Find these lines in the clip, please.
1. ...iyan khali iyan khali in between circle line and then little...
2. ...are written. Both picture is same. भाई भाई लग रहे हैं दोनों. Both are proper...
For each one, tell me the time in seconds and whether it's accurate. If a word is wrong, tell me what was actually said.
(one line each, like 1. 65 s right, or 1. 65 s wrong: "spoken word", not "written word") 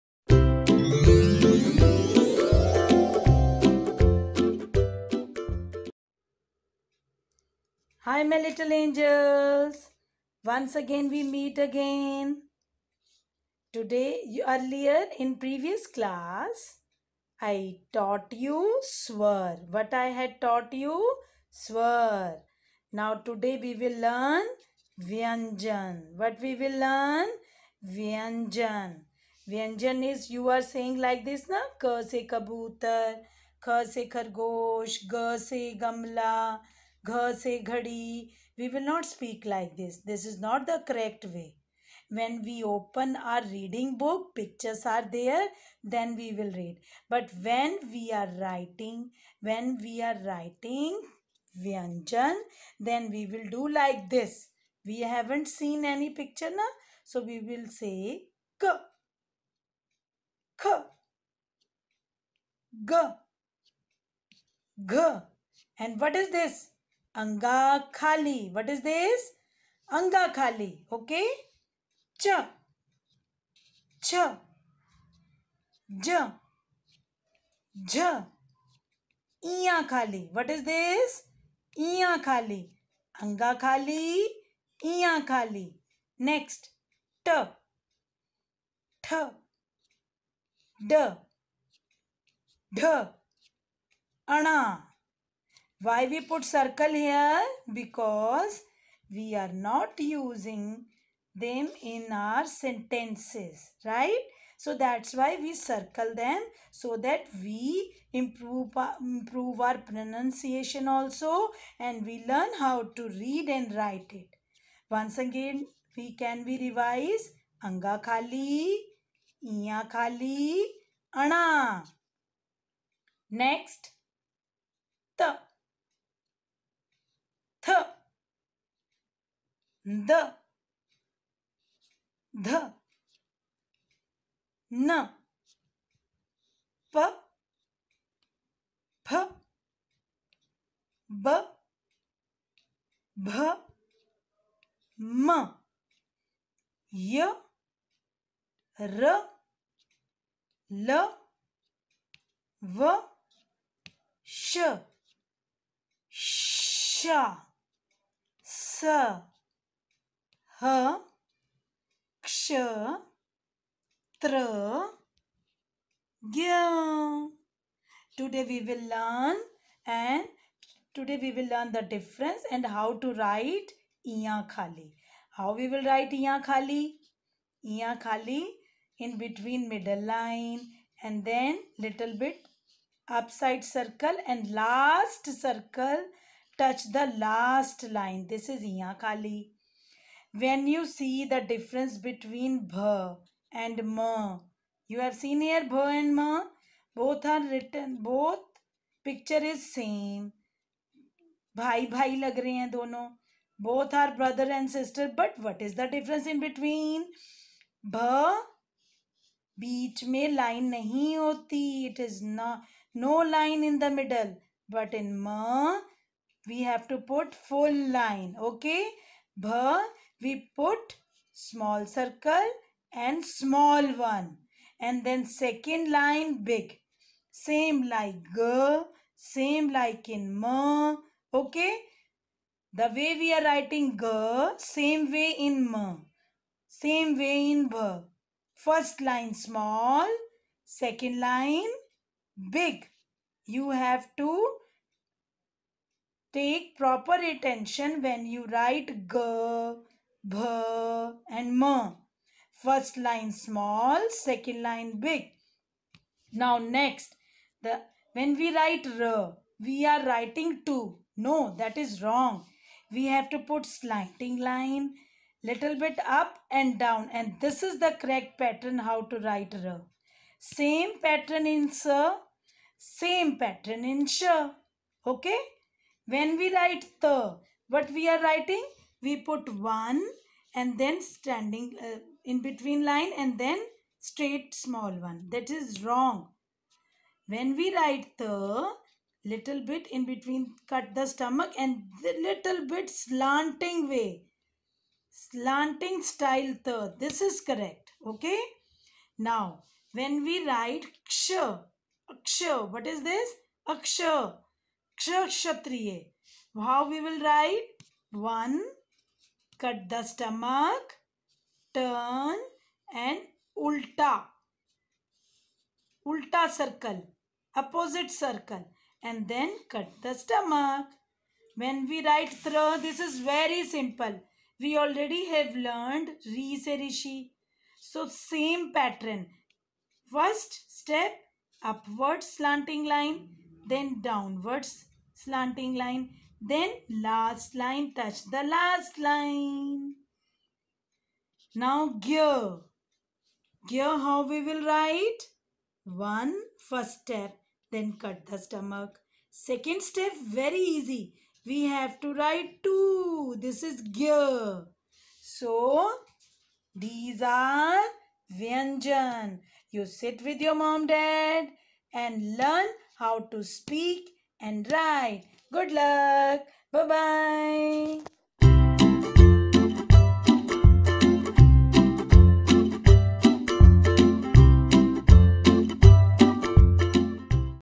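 1. 176 s wrong: "middle", not "circle"
2. 197 s wrong: "brother", not "proper".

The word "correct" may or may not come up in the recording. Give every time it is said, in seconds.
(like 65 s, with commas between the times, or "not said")
40 s, 267 s, 297 s.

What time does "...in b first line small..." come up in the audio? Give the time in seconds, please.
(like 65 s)
237 s.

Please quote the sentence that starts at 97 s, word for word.
Because we are not using them in our sentences, right?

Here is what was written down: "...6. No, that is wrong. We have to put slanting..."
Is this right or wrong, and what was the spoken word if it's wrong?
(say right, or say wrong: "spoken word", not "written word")
wrong: "2", not "6".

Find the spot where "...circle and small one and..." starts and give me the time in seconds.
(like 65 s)
221 s.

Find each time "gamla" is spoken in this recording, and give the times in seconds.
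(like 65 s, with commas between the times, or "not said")
35 s.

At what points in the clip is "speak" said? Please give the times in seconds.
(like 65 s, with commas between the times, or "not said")
39 s, 363 s.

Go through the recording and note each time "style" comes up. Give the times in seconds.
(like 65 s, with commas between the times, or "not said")
296 s.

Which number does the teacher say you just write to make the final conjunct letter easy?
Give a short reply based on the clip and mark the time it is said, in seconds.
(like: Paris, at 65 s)
2, at 351 s.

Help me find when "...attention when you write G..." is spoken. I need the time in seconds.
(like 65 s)
247 s.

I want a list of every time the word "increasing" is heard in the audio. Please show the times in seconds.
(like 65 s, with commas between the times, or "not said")
not said.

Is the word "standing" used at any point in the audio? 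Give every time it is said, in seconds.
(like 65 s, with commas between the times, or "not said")
281 s.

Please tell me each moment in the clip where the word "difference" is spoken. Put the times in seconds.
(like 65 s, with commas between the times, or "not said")
171 s, 191 s, 205 s.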